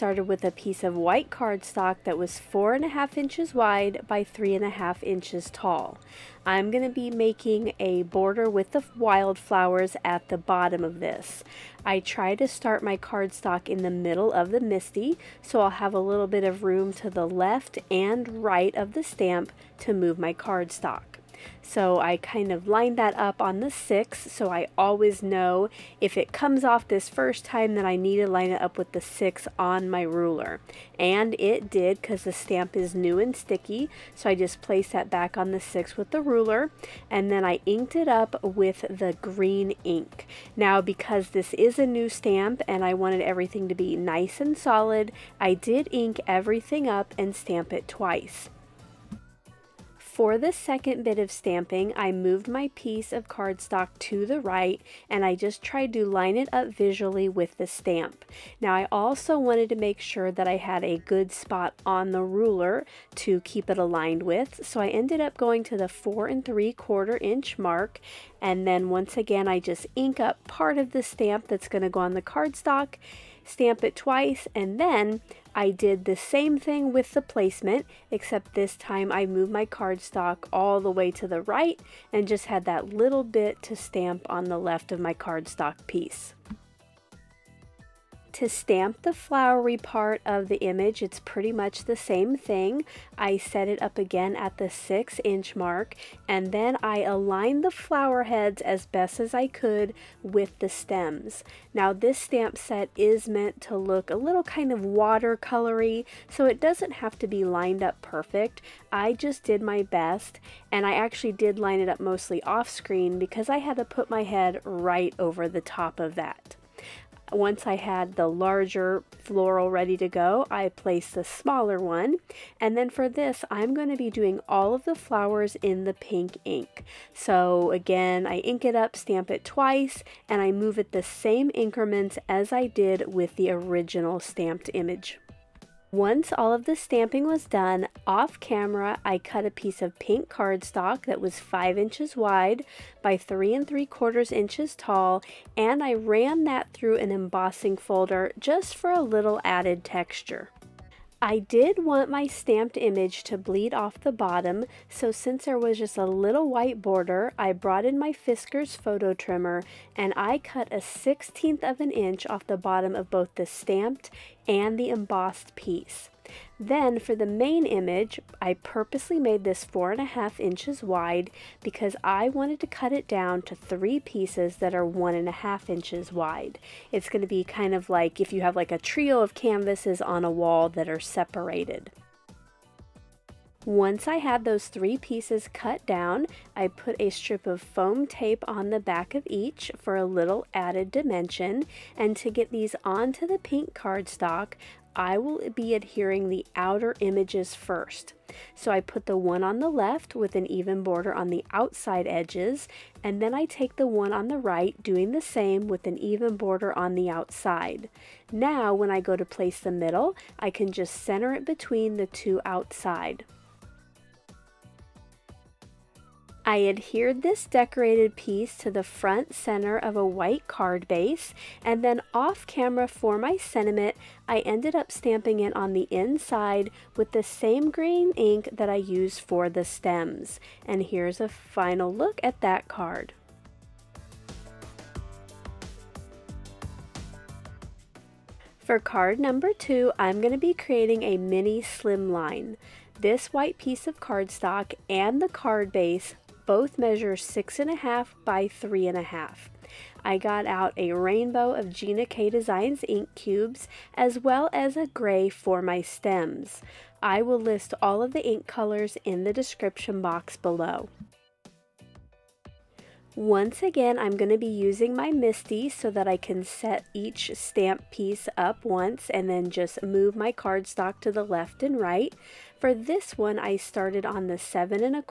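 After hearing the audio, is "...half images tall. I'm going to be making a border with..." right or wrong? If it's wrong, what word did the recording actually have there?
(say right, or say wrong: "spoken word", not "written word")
wrong: "inches", not "images".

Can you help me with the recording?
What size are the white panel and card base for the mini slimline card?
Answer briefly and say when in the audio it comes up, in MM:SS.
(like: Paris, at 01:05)
6.5 by 3.5, at 04:07.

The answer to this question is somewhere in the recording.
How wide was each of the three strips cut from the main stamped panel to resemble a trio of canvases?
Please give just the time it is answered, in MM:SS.
02:54.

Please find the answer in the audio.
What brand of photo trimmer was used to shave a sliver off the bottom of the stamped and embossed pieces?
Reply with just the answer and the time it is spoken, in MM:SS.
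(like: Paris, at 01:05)
Fiskars, at 02:38.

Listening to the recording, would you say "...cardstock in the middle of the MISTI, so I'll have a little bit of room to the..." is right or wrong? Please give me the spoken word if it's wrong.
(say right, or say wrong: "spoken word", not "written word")
right.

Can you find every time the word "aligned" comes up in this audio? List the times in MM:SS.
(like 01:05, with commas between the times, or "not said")
01:03, 01:37.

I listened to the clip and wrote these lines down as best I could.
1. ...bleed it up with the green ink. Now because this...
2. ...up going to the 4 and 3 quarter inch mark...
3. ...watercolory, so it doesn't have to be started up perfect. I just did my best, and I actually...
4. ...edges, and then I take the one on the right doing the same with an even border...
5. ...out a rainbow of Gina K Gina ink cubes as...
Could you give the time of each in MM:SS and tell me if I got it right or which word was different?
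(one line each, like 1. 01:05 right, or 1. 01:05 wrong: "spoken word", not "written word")
1. 00:37 wrong: "inked", not "bleed"
2. 01:05 right
3. 01:44 wrong: "lined", not "started"
4. 03:22 right
5. 04:10 wrong: "Designs", not "Gina".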